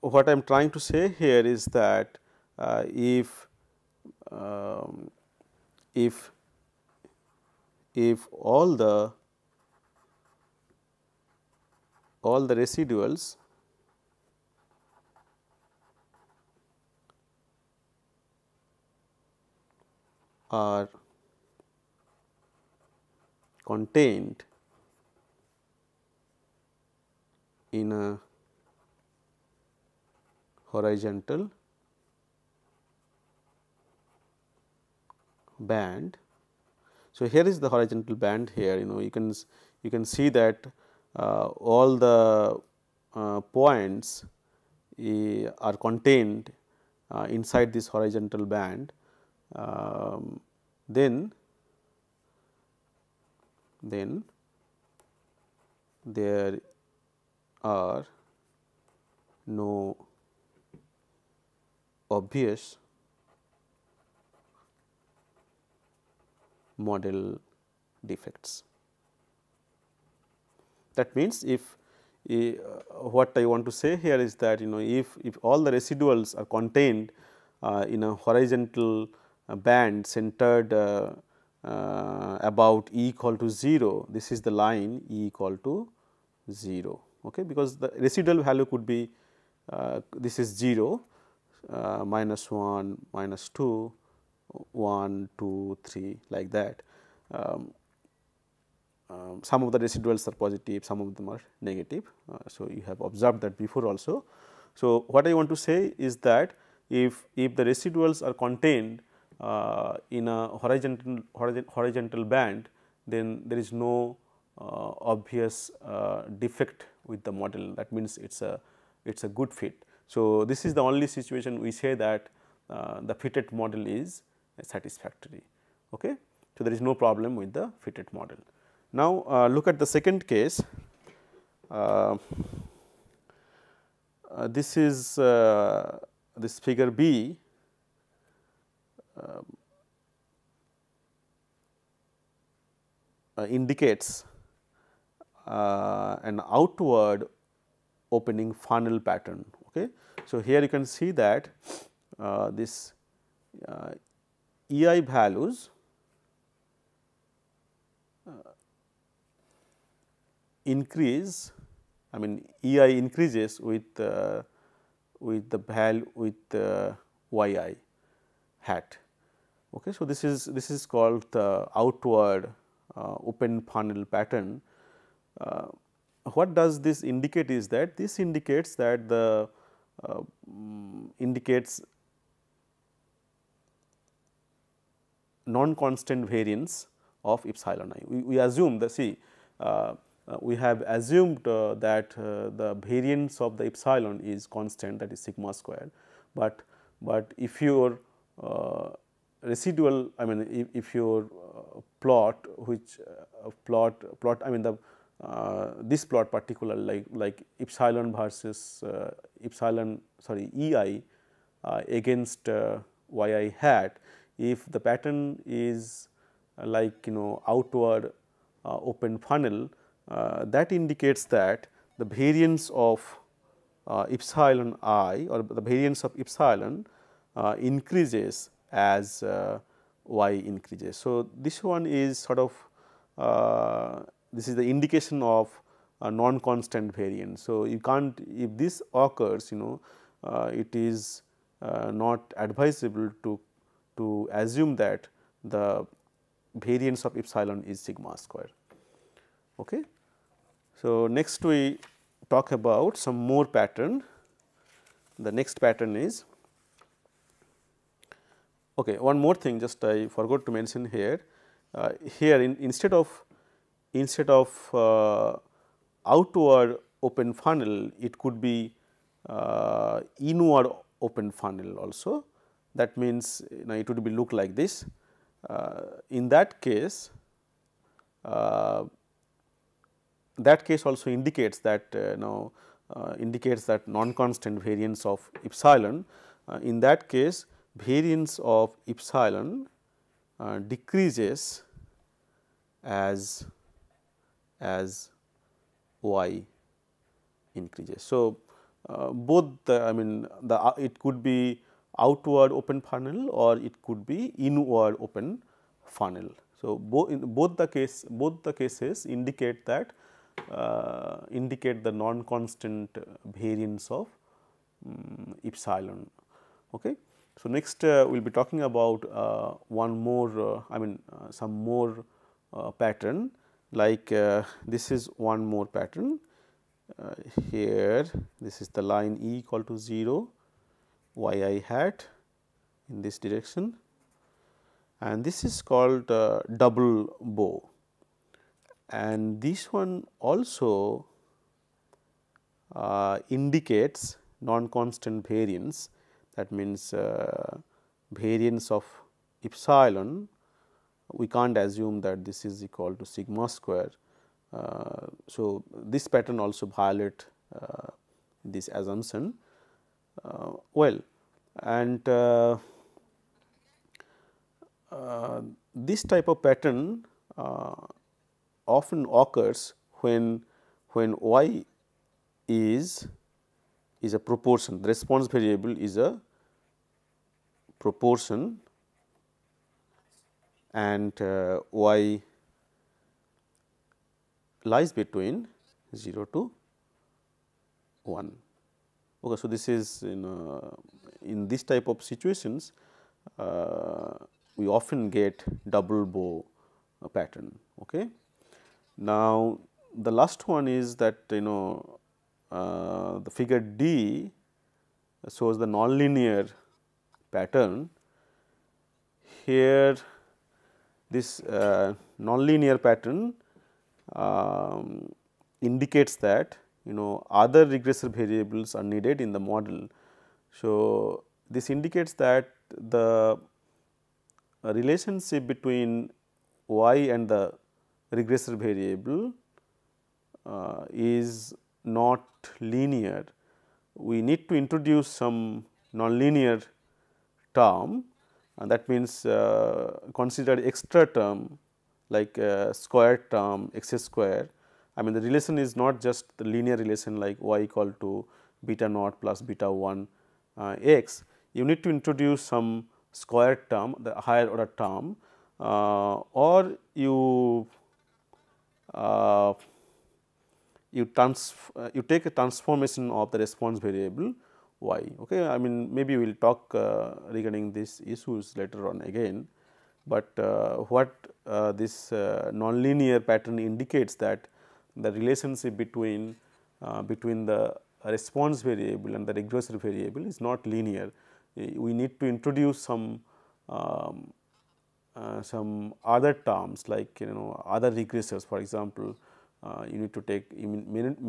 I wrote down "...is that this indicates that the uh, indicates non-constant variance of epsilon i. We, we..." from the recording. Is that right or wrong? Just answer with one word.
right.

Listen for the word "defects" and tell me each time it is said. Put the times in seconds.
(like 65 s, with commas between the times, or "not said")
68 s, 116 s.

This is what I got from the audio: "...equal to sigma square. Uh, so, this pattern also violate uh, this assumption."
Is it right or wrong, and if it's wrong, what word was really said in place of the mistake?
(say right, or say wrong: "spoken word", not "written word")
right.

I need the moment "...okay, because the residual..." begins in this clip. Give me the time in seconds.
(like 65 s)
87 s.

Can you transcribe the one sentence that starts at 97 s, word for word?
Um, um, some of the residuals are positive, some of them are negative.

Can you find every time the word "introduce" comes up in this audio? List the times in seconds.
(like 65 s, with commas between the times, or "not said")
434 s, 451 s, 482 s.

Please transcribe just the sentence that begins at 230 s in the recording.
So, this one is sort of this is the indication of a non constant variance.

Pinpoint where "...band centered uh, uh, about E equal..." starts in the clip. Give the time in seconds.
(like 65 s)
79 s.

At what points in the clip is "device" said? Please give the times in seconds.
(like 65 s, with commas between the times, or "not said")
not said.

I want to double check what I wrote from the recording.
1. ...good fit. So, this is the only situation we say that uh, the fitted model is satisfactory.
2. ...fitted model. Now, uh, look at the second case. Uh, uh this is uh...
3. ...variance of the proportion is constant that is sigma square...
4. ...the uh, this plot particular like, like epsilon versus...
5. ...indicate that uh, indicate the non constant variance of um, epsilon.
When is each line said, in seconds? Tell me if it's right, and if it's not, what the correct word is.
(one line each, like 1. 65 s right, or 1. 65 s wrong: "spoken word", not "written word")
1. 119 s right
2. 127 s right
3. 192 s wrong: "epsilon", not "proportion"
4. 204 s right
5. 309 s right.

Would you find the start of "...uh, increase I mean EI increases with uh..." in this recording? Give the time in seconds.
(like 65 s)
158 s.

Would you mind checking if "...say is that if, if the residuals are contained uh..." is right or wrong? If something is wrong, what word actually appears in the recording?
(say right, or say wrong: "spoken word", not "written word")
right.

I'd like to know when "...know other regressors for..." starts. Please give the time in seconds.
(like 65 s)
487 s.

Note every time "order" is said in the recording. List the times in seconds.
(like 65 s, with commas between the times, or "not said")
454 s.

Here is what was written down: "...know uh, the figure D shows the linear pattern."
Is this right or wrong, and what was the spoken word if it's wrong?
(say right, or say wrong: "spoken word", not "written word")
wrong: "nonlinear", not "linear".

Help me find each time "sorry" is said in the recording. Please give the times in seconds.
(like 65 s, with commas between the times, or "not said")
210 s.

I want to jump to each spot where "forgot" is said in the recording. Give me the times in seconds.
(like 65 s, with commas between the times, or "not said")
260 s.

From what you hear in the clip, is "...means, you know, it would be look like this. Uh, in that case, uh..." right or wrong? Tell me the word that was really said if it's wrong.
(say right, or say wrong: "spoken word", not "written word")
right.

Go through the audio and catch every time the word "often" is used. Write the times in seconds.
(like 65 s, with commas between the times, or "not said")
368 s, 394 s.